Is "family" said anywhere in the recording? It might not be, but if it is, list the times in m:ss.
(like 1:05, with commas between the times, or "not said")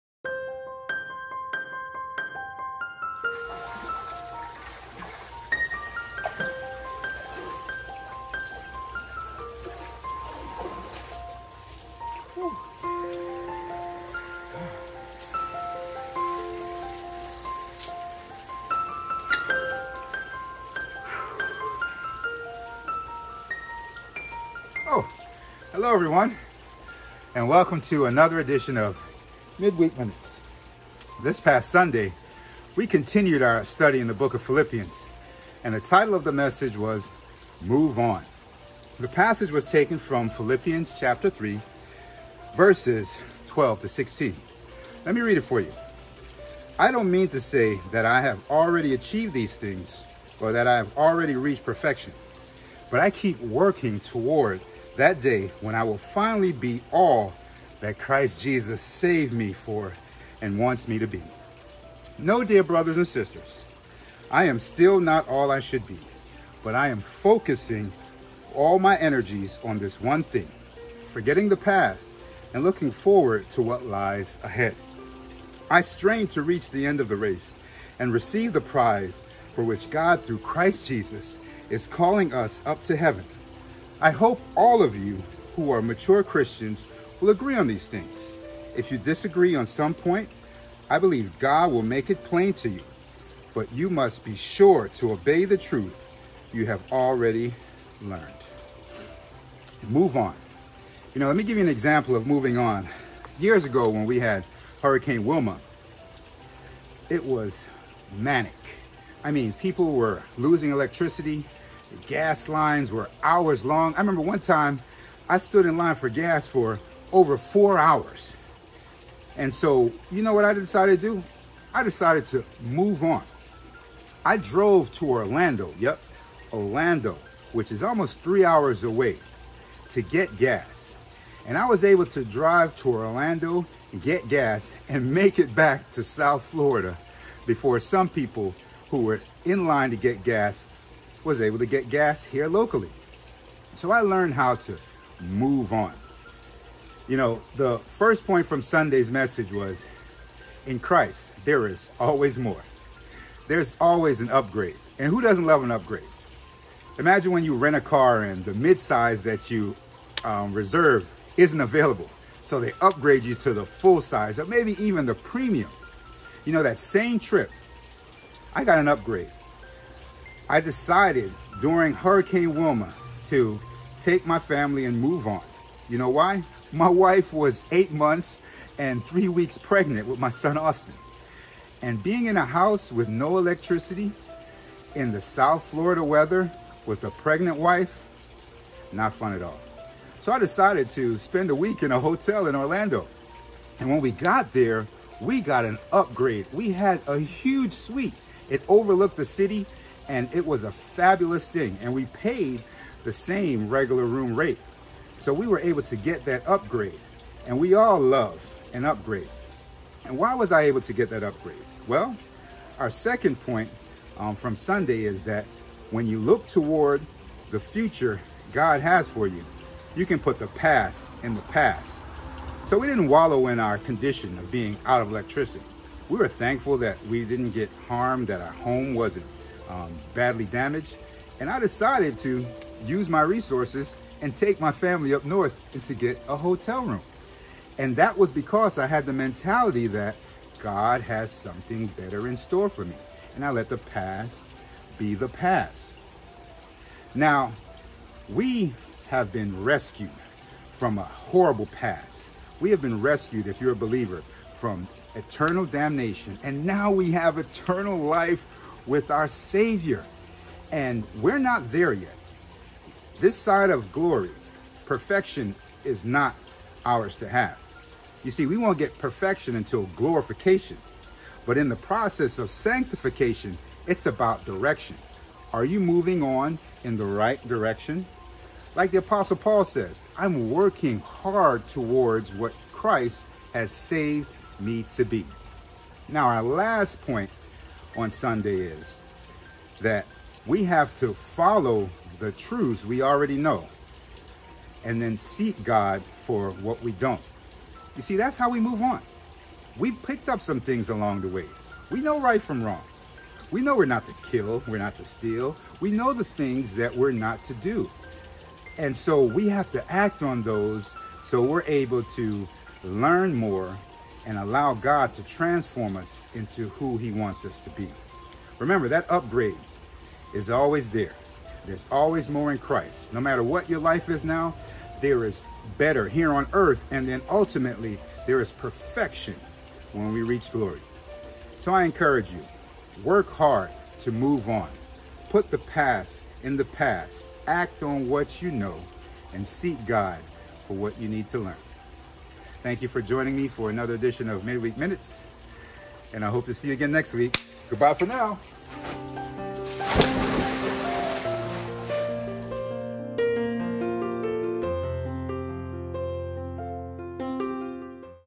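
2:54, 3:54.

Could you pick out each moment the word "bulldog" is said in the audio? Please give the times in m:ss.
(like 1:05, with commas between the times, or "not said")
not said.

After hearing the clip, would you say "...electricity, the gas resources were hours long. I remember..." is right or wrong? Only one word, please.
wrong.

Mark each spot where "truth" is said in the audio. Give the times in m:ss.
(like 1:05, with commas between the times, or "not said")
1:35, 4:52.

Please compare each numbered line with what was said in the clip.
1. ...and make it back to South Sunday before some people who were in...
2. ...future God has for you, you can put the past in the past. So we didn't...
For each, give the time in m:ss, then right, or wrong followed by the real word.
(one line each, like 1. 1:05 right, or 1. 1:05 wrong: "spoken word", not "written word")
1. 2:14 wrong: "Florida", not "Sunday"
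2. 3:37 right.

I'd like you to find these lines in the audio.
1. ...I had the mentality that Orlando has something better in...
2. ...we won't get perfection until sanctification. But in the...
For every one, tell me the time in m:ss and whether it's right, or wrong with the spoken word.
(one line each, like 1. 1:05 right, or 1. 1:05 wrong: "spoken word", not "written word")
1. 3:58 wrong: "God", not "Orlando"
2. 4:28 wrong: "glorification", not "sanctification".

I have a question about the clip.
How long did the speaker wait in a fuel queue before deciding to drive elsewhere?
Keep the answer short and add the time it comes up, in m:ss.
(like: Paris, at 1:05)
over 4 hours, at 1:57.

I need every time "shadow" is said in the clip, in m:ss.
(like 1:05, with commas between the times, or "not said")
not said.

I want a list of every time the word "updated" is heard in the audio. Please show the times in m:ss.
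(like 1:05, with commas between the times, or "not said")
not said.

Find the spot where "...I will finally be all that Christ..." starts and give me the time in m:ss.
0:55.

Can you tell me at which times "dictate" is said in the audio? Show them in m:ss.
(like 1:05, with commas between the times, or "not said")
not said.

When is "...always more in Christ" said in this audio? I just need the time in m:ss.
5:21.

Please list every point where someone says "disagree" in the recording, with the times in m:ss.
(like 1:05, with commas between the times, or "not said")
1:28.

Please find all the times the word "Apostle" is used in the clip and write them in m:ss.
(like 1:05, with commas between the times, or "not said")
4:38.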